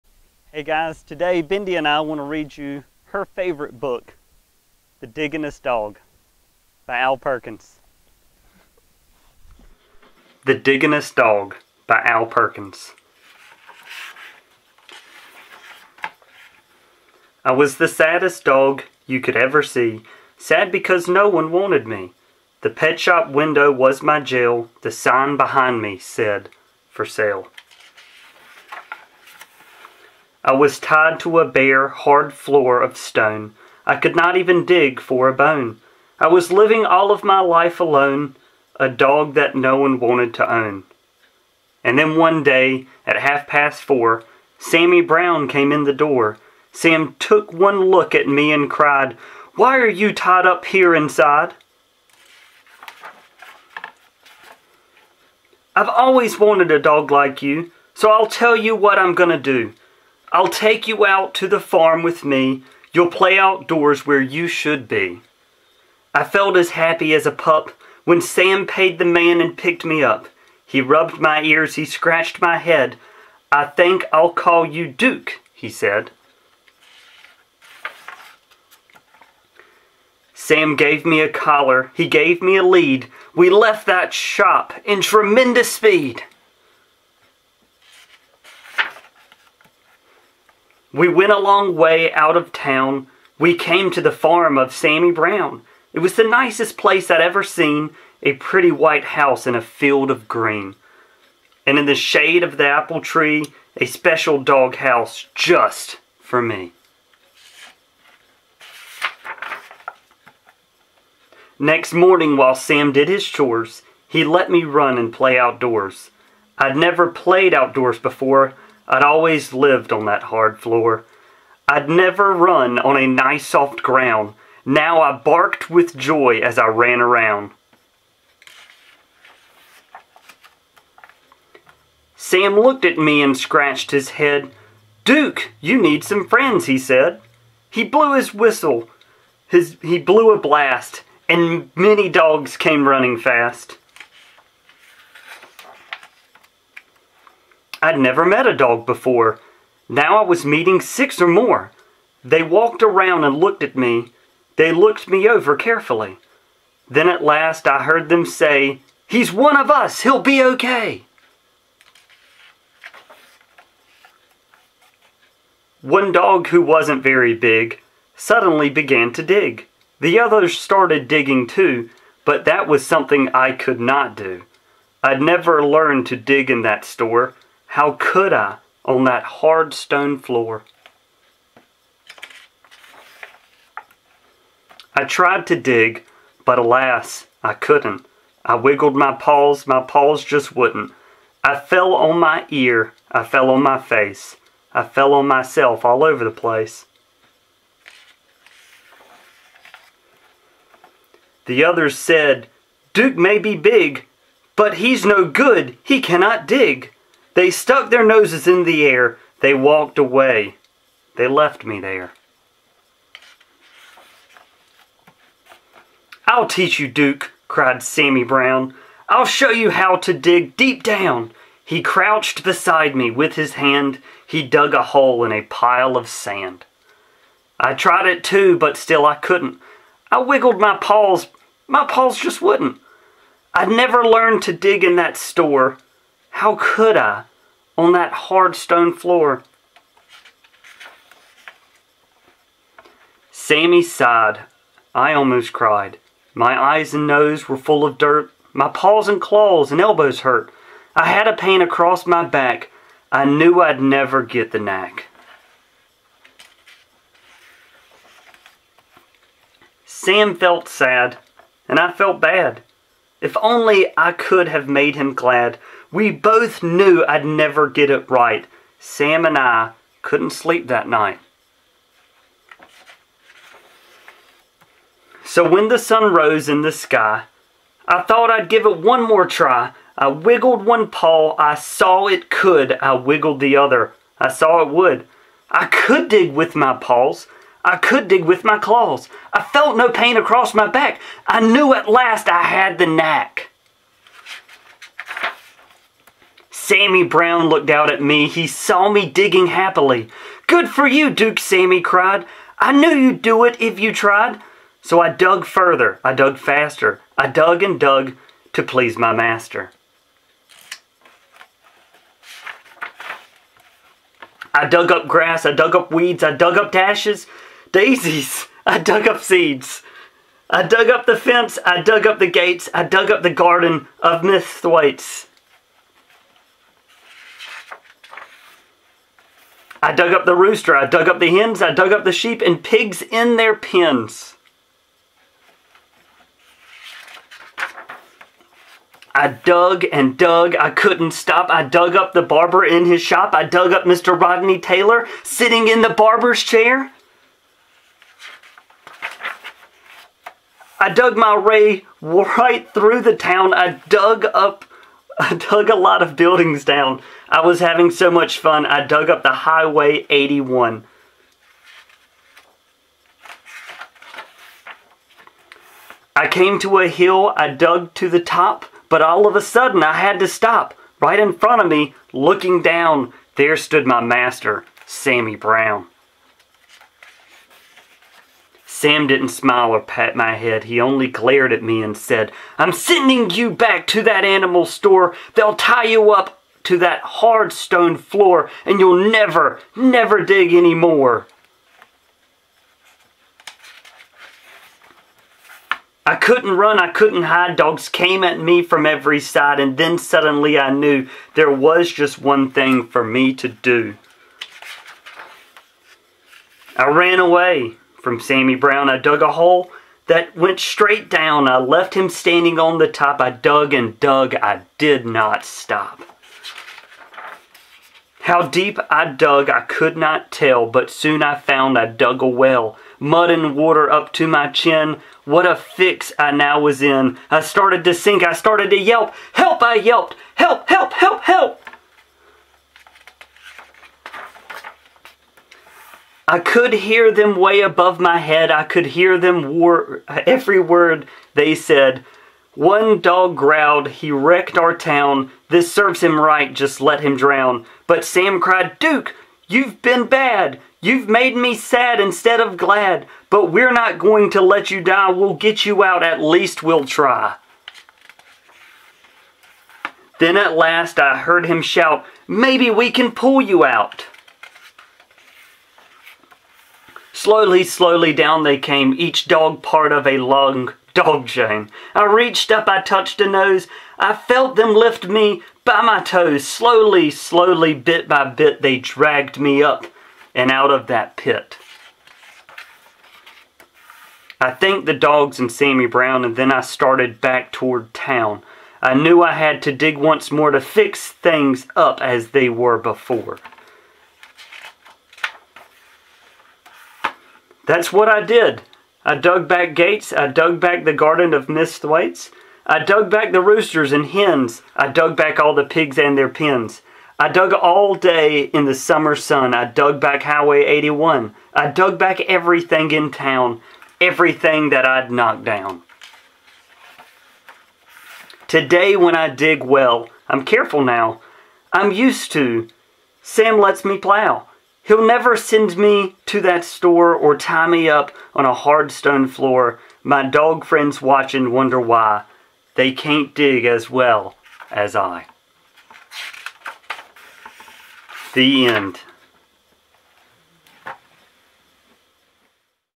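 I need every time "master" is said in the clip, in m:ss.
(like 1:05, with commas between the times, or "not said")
5:09, 6:14.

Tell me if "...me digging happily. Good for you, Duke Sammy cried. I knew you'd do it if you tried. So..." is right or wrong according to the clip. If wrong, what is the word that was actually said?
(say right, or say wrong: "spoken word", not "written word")
right.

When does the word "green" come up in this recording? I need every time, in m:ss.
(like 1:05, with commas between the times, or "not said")
1:40.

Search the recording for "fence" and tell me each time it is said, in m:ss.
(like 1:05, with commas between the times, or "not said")
5:21.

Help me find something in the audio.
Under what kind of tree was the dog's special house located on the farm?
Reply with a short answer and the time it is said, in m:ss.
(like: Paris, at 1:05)
apple tree, at 1:42.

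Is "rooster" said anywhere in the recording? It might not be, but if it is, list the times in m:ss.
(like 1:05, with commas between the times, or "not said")
5:30, 8:23.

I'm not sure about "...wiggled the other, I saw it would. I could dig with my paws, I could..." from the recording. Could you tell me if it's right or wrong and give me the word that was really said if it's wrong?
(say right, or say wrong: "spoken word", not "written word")
right.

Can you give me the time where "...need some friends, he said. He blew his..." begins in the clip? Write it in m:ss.
2:15.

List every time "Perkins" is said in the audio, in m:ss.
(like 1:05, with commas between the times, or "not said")
0:07, 0:12.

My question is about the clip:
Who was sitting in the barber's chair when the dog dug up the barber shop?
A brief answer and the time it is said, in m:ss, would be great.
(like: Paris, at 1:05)
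Mr. Rodney Taylor, at 5:43.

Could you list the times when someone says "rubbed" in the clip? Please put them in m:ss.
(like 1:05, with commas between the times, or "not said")
1:10.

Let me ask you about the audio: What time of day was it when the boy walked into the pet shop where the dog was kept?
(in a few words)
half past four.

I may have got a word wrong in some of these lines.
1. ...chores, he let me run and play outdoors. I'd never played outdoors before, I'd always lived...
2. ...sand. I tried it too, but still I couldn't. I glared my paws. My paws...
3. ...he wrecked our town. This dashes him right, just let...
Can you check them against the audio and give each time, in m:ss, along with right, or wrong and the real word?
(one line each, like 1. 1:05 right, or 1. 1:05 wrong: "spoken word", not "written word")
1. 1:53 right
2. 3:46 wrong: "wiggled", not "glared"
3. 7:23 wrong: "serves", not "dashes".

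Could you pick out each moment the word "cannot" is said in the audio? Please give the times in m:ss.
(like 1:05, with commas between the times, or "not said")
3:26.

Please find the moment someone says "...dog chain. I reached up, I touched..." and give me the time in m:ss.
7:50.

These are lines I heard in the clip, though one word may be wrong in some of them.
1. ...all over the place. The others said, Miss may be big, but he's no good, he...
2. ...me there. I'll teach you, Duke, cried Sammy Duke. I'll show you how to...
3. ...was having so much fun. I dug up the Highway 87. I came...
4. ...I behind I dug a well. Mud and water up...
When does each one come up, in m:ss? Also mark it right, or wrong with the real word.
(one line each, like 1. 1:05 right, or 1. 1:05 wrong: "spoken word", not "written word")
1. 3:15 wrong: "Duke", not "Miss"
2. 3:31 wrong: "Brown", not "Duke"
3. 5:57 wrong: "81", not "87"
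4. 7:01 wrong: "found", not "behind".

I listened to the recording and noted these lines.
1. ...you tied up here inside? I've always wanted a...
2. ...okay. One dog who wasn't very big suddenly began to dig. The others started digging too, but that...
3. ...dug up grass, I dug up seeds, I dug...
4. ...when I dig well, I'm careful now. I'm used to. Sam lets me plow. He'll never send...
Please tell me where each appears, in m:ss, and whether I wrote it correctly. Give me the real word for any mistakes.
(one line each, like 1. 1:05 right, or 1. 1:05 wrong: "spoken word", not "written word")
1. 0:49 right
2. 2:40 right
3. 5:14 wrong: "weeds", not "seeds"
4. 8:38 right.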